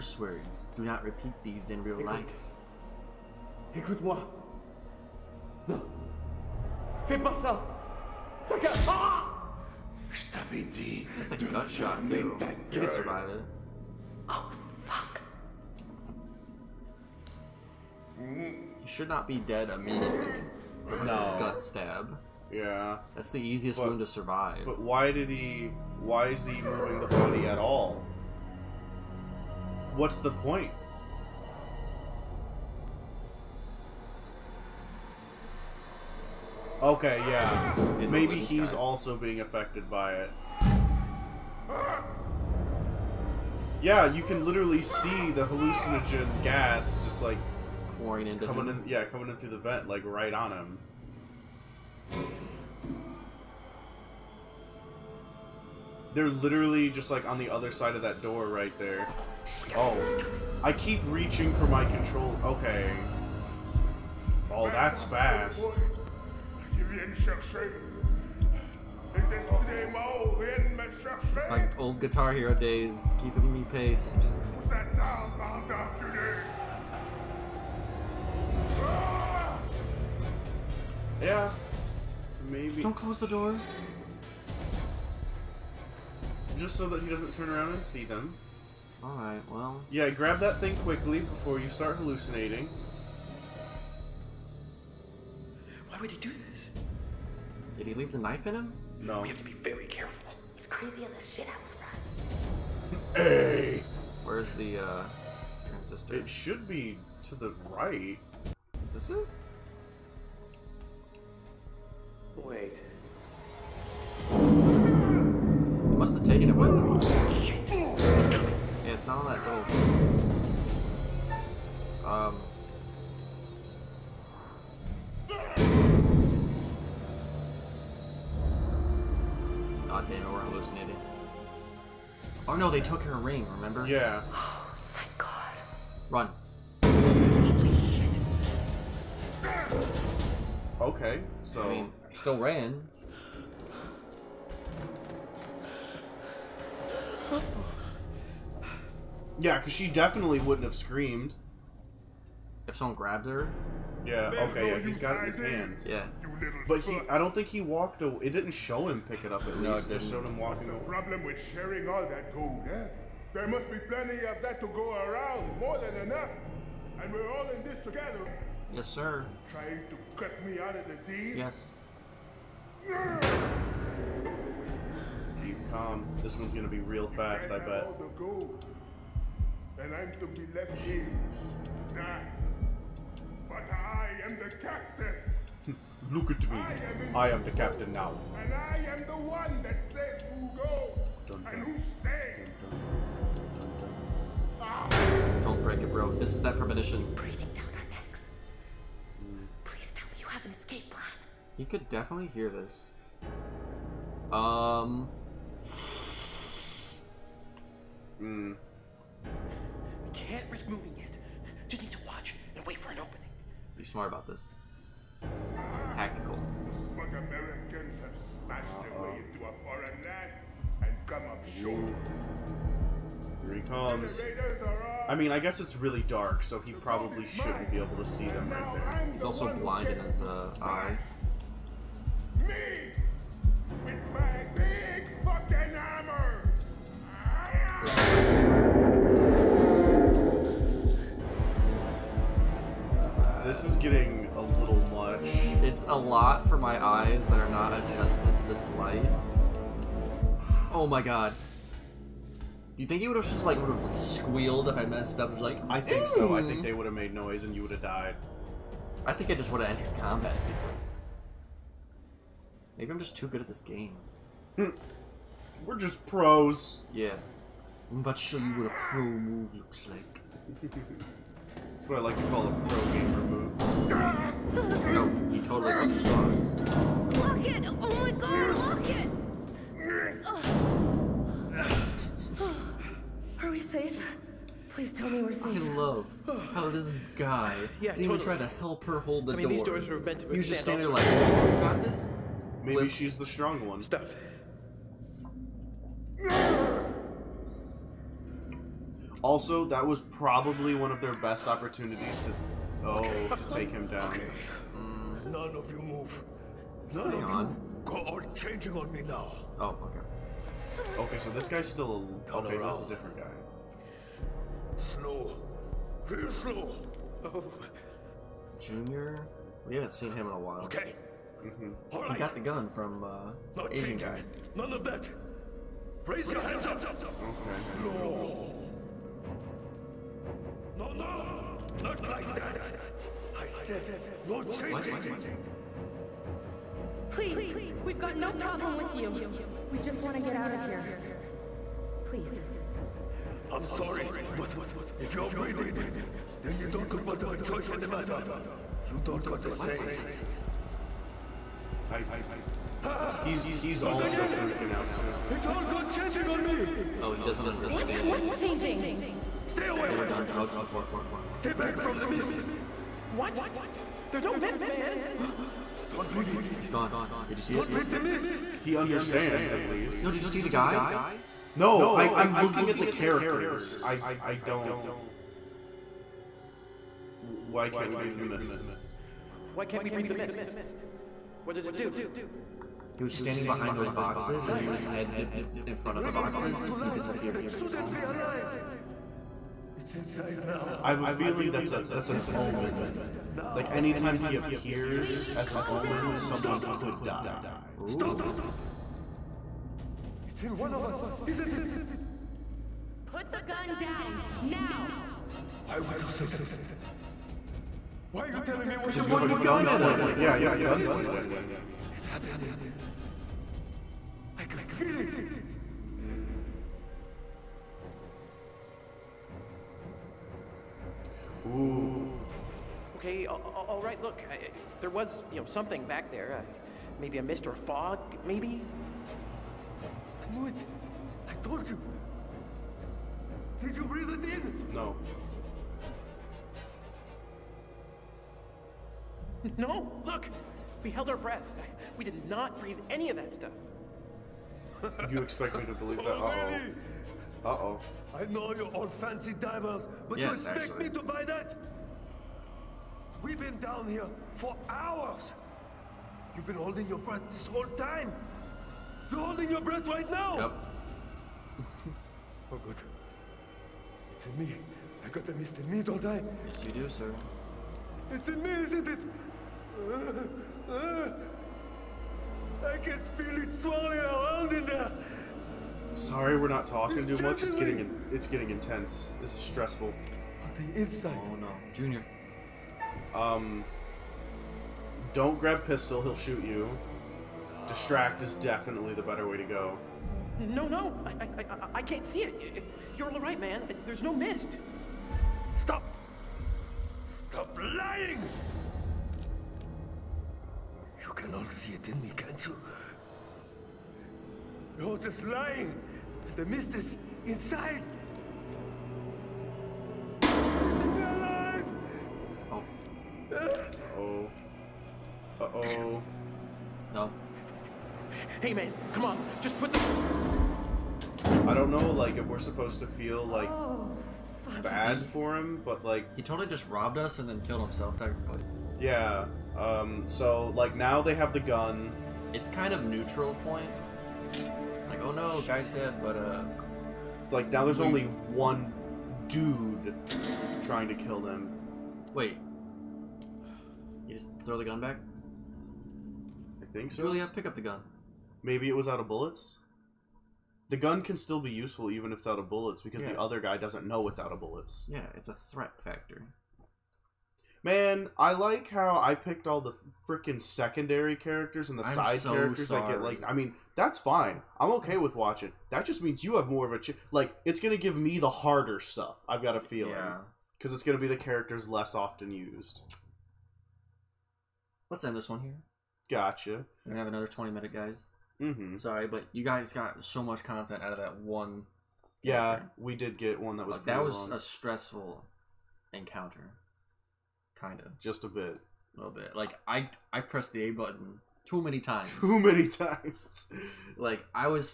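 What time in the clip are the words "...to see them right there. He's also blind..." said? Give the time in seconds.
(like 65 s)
227 s.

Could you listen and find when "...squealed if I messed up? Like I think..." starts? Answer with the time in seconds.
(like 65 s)
253 s.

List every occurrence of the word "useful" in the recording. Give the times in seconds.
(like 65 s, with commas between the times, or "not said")
551 s.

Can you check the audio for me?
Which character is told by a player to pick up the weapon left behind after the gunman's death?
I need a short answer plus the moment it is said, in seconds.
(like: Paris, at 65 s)
Julia, at 547 s.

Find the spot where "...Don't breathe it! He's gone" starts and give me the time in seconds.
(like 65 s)
365 s.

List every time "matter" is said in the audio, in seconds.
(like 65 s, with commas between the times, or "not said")
347 s.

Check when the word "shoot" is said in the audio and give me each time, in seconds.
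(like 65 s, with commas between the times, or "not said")
486 s.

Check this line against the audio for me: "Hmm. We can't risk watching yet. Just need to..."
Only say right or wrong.
wrong.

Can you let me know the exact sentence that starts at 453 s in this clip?
We've been down here for hours.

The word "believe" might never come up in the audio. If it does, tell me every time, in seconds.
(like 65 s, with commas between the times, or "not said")
445 s.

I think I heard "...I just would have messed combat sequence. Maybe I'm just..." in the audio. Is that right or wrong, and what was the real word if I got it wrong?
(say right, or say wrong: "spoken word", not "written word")
wrong: "entered", not "messed".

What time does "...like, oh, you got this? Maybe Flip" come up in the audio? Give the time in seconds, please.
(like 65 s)
290 s.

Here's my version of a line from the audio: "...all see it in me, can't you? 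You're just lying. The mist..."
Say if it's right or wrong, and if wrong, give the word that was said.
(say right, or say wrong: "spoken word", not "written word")
right.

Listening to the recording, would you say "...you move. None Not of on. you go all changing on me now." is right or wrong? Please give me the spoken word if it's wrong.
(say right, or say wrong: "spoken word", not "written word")
wrong: "Hang", not "Not".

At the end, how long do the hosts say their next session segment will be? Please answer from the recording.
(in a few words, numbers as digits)
20 minutes.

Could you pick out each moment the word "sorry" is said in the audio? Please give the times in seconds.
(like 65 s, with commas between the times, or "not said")
343 s, 475 s, 562 s, 578 s.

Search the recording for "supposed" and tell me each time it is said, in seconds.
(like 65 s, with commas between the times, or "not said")
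522 s.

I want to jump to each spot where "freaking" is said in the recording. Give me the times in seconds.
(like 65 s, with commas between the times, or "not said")
354 s, 560 s.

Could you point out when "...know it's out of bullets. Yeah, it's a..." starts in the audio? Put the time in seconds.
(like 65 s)
553 s.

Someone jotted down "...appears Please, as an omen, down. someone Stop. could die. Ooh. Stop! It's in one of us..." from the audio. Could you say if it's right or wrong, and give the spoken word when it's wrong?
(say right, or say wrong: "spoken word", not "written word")
right.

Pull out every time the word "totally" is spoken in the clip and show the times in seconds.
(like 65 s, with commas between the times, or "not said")
275 s, 287 s, 526 s.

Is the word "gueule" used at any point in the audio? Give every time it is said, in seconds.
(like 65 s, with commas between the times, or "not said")
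12 s.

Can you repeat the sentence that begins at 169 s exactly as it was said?
Trying to cut me out of the deal?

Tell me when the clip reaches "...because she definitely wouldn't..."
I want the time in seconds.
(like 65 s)
149 s.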